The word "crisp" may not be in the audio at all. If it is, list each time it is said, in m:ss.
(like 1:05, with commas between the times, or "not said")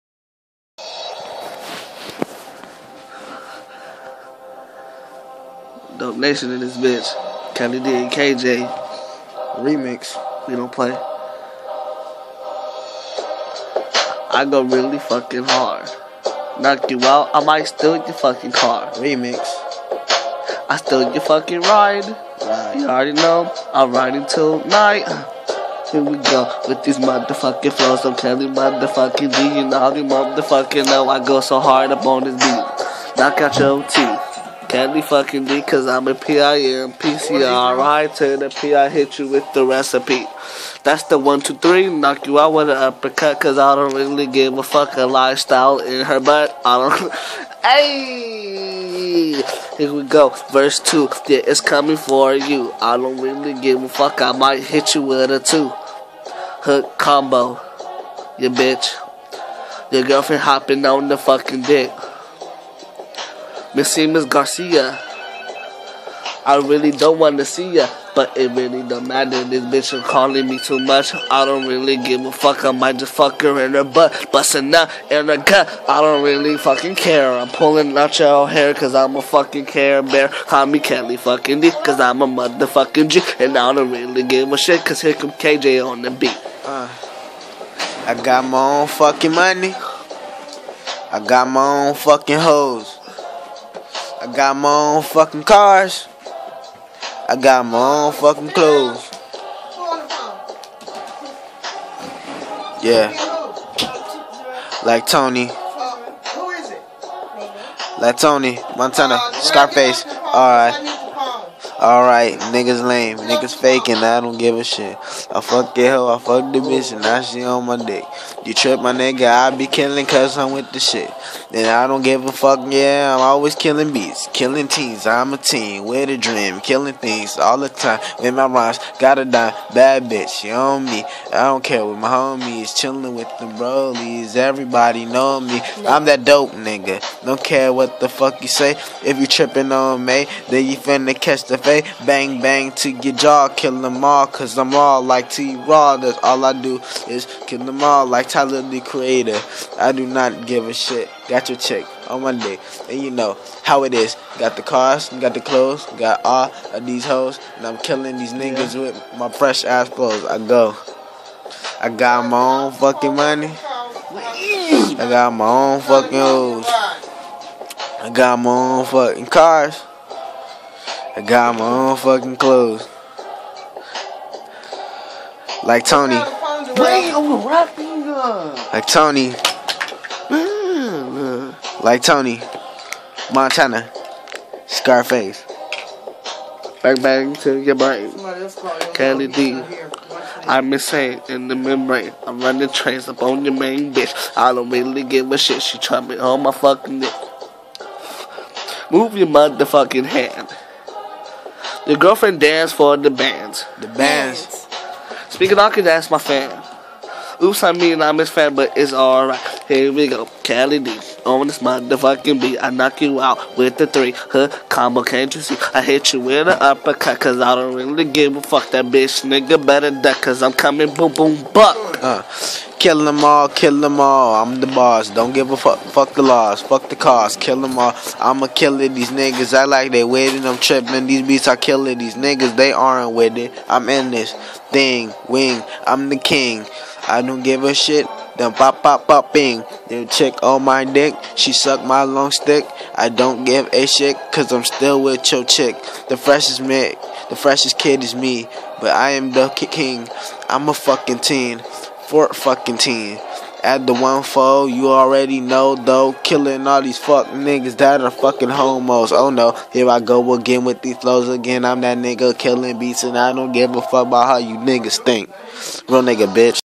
not said.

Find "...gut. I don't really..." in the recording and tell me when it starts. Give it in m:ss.
1:15.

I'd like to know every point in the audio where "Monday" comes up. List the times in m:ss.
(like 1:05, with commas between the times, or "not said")
2:32.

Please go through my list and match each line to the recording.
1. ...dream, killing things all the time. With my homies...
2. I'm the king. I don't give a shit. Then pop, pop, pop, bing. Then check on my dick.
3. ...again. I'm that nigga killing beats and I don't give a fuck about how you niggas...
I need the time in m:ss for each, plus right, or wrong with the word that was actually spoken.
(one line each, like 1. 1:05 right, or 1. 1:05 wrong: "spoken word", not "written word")
1. 2:06 wrong: "rhymes", not "homies"
2. 3:55 right
3. 4:21 right.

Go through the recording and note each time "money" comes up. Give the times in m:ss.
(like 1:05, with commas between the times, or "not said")
1:29, 2:43.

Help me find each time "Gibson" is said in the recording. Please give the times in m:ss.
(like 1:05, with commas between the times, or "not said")
not said.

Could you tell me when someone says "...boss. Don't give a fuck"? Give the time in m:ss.
3:44.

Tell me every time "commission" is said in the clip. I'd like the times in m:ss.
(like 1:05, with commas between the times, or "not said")
not said.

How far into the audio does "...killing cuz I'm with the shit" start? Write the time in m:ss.
1:59.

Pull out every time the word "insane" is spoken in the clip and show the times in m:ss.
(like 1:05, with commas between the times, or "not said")
3:10.